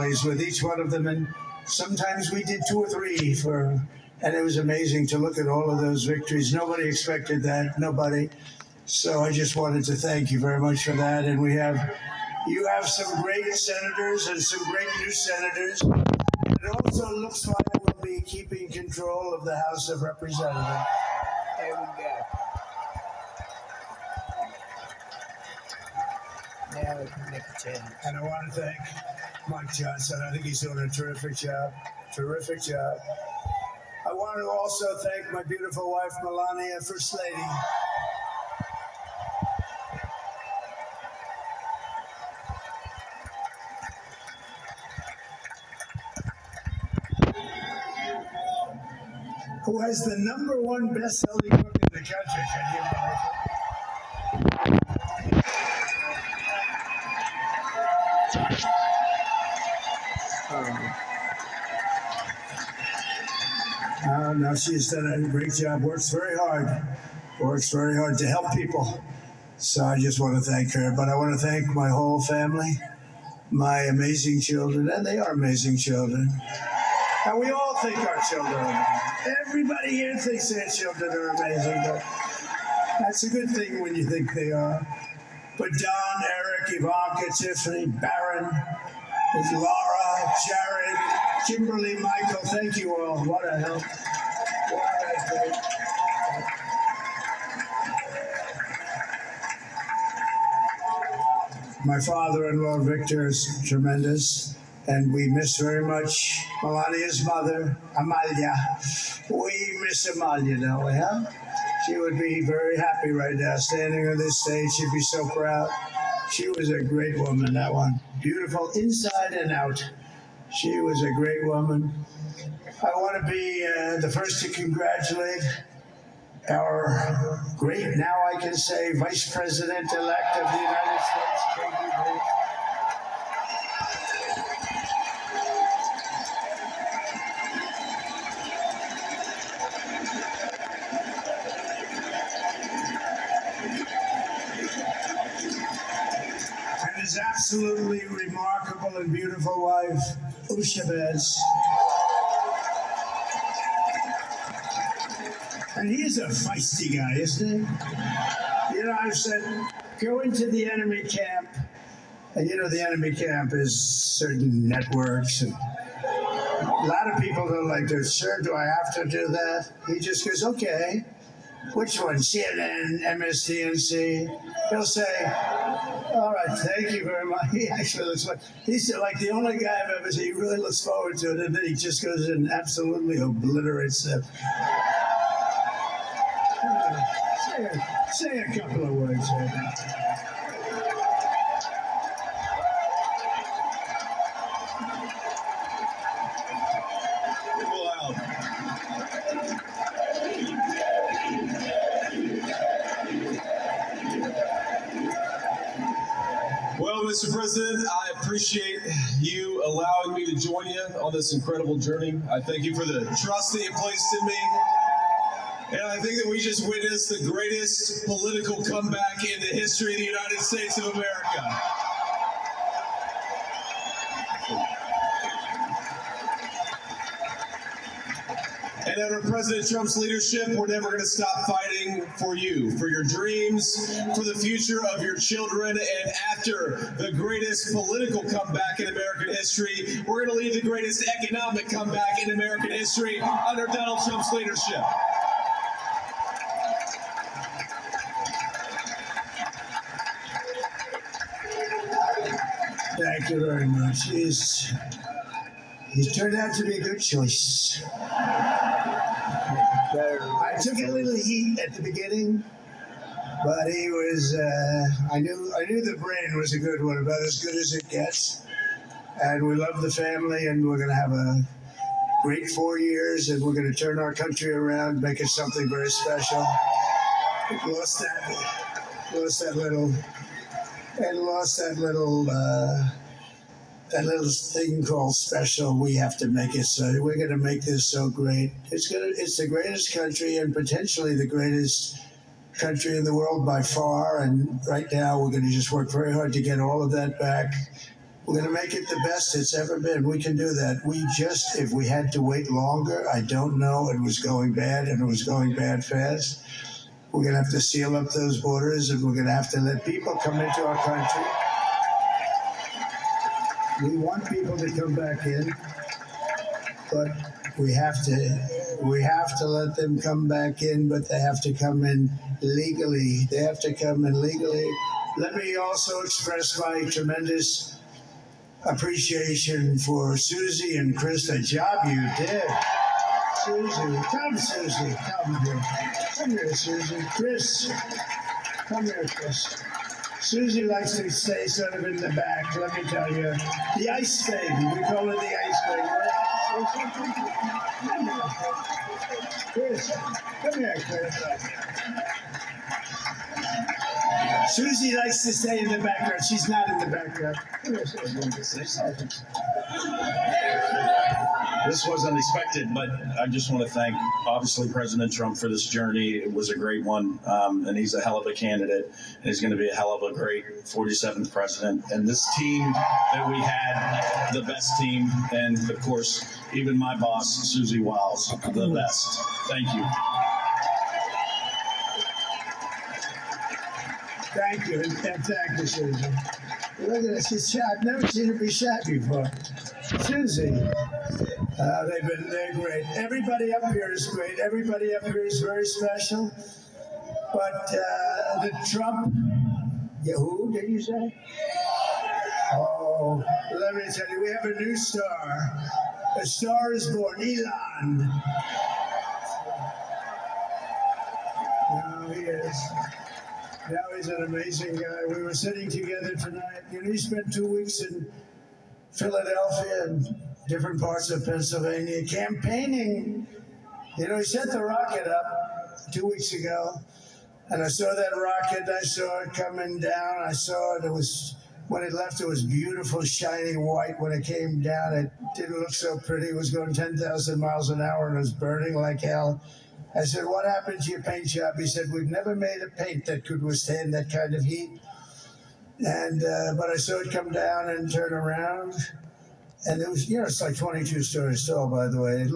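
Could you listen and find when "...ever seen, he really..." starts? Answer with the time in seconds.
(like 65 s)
179 s.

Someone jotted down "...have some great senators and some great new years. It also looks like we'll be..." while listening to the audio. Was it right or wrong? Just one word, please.
wrong.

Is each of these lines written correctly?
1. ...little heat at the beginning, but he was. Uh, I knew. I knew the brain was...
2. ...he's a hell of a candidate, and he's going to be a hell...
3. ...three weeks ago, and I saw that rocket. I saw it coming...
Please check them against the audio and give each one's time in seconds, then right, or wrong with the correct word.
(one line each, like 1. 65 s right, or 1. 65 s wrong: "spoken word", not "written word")
1. 260 s right
2. 367 s right
3. 425 s wrong: "two", not "three".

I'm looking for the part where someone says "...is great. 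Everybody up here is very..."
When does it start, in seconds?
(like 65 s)
393 s.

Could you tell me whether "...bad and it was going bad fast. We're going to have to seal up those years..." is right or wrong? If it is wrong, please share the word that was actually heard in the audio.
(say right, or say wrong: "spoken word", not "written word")
wrong: "borders", not "years".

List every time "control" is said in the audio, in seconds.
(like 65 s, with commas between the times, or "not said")
18 s.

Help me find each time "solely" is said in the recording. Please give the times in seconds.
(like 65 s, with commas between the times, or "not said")
not said.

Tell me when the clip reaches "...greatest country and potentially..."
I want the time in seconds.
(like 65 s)
289 s.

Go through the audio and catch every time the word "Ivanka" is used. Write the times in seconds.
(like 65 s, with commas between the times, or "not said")
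86 s.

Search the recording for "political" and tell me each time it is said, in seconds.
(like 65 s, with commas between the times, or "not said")
218 s, 237 s.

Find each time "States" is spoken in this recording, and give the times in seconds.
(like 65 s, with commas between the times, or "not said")
130 s, 220 s.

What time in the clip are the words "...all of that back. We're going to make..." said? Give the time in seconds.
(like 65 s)
296 s.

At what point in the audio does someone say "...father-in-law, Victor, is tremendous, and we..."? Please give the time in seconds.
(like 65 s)
101 s.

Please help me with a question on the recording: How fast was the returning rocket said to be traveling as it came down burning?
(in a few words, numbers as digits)
10,000 miles an hour.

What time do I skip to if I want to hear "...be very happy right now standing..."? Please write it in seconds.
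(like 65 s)
112 s.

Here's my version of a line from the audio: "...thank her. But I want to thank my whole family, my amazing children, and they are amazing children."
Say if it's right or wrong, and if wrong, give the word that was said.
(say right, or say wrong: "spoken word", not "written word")
right.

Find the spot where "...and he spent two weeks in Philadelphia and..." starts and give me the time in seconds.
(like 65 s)
416 s.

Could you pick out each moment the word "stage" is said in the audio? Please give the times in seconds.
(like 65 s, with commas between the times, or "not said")
114 s.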